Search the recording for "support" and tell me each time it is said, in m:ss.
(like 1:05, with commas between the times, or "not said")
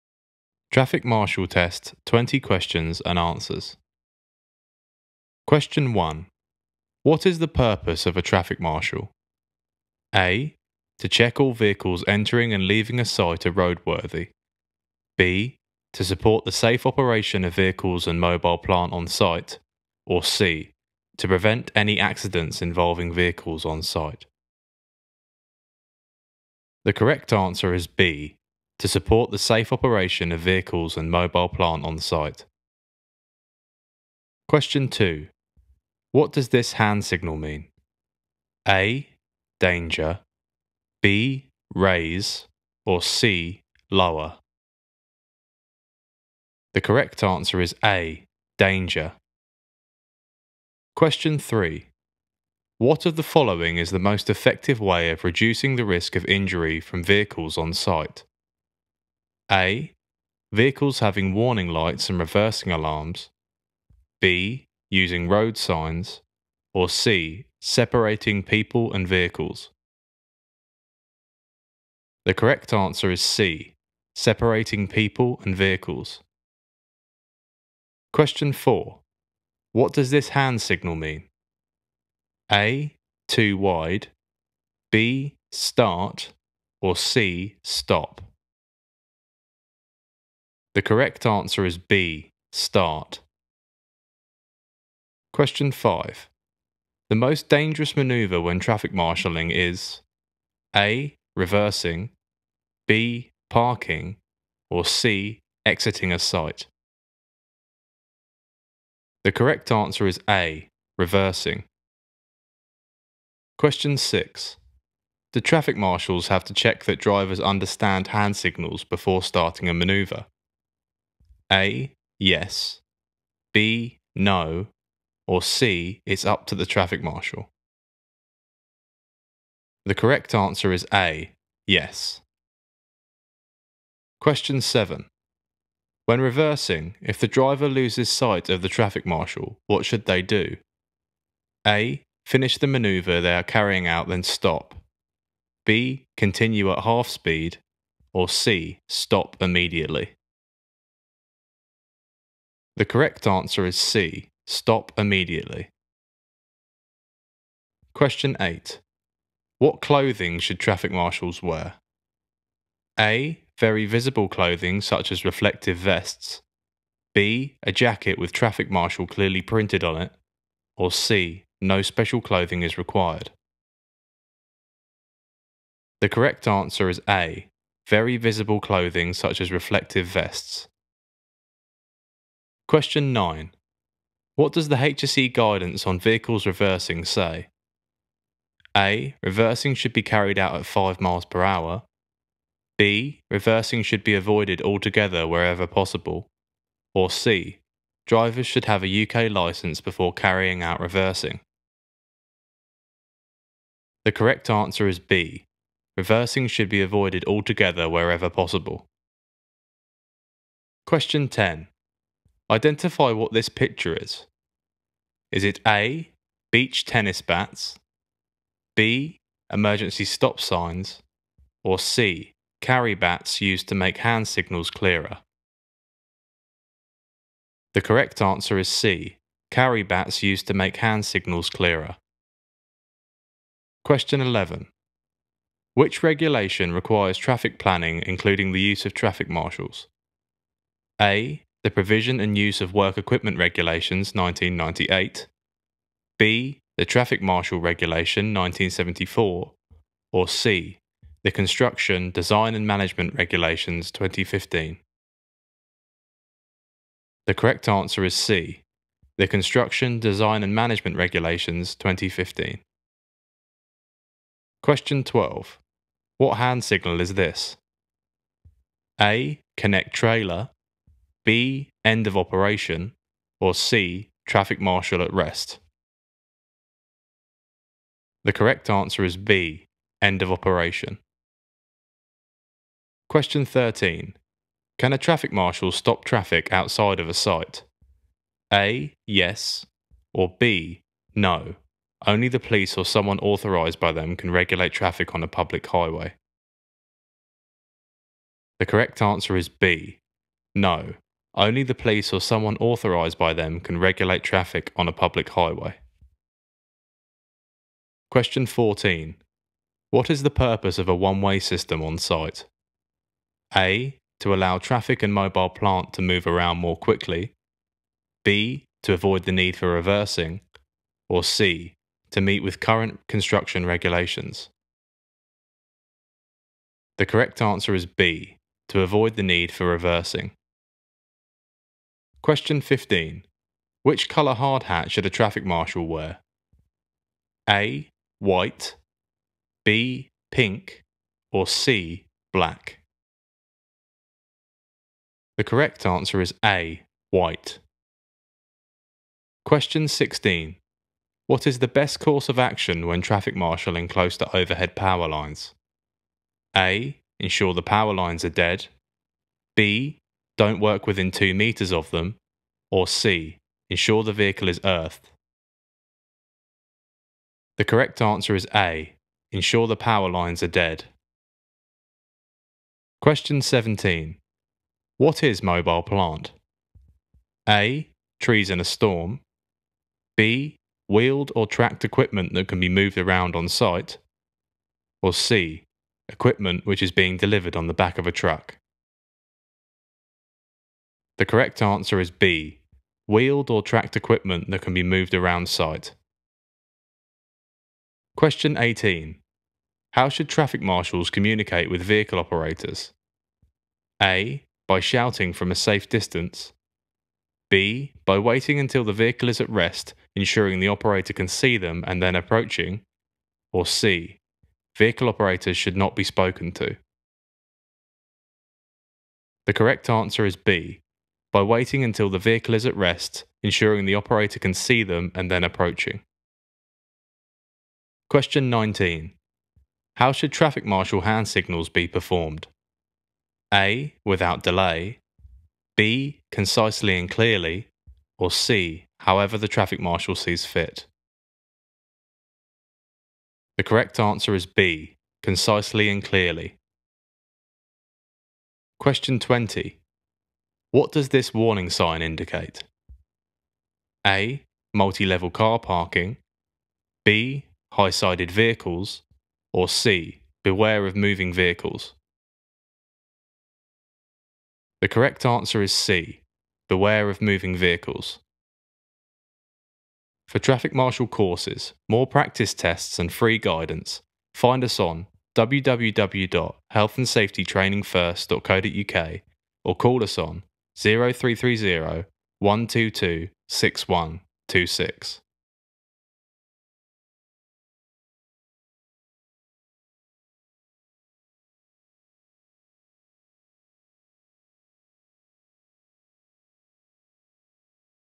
0:16, 0:28.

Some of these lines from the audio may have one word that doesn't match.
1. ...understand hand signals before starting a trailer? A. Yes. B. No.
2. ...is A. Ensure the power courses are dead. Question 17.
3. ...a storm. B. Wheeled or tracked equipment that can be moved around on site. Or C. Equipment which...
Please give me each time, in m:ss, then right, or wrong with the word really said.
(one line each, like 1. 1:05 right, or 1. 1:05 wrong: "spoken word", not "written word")
1. 1:57 wrong: "maneuver", not "trailer"
2. 6:08 wrong: "lines", not "courses"
3. 6:18 right.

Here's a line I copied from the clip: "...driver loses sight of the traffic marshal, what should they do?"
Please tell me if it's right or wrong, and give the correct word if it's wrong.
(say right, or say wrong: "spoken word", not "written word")
right.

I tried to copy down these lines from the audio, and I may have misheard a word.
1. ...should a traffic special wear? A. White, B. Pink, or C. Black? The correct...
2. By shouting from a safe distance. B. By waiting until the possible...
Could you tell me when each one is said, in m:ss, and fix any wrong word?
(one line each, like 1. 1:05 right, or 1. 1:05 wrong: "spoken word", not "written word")
1. 5:34 wrong: "marshal", not "special"
2. 6:44 wrong: "vehicle", not "possible".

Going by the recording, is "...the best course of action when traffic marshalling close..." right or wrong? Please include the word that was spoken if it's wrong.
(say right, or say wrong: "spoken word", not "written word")
right.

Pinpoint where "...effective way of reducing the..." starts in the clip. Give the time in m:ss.
0:54.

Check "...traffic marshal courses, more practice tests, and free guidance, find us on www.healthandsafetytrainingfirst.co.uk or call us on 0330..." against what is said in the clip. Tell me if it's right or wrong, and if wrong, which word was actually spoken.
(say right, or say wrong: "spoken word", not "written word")
right.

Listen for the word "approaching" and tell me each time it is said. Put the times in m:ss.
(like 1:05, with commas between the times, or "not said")
6:52, 7:05.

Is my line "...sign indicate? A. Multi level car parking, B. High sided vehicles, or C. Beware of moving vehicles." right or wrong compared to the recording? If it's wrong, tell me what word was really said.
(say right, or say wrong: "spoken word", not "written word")
right.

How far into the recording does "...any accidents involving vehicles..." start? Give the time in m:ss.
0:21.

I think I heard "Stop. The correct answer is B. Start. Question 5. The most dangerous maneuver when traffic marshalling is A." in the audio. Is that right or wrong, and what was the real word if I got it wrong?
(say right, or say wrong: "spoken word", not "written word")
right.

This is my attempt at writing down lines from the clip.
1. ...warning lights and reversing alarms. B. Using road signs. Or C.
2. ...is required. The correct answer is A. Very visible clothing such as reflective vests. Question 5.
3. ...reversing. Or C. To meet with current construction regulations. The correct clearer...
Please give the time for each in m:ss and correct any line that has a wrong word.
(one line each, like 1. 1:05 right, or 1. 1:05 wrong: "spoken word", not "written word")
1. 1:01 right
2. 2:52 wrong: "9", not "5"
3. 5:19 wrong: "answer", not "clearer".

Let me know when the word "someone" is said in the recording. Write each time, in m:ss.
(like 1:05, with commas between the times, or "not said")
4:52, 5:02.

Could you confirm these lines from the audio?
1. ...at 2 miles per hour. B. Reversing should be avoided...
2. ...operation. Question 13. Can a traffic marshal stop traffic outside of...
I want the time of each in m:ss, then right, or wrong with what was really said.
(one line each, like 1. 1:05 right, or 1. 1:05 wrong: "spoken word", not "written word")
1. 3:10 wrong: "5", not "2"
2. 4:40 right.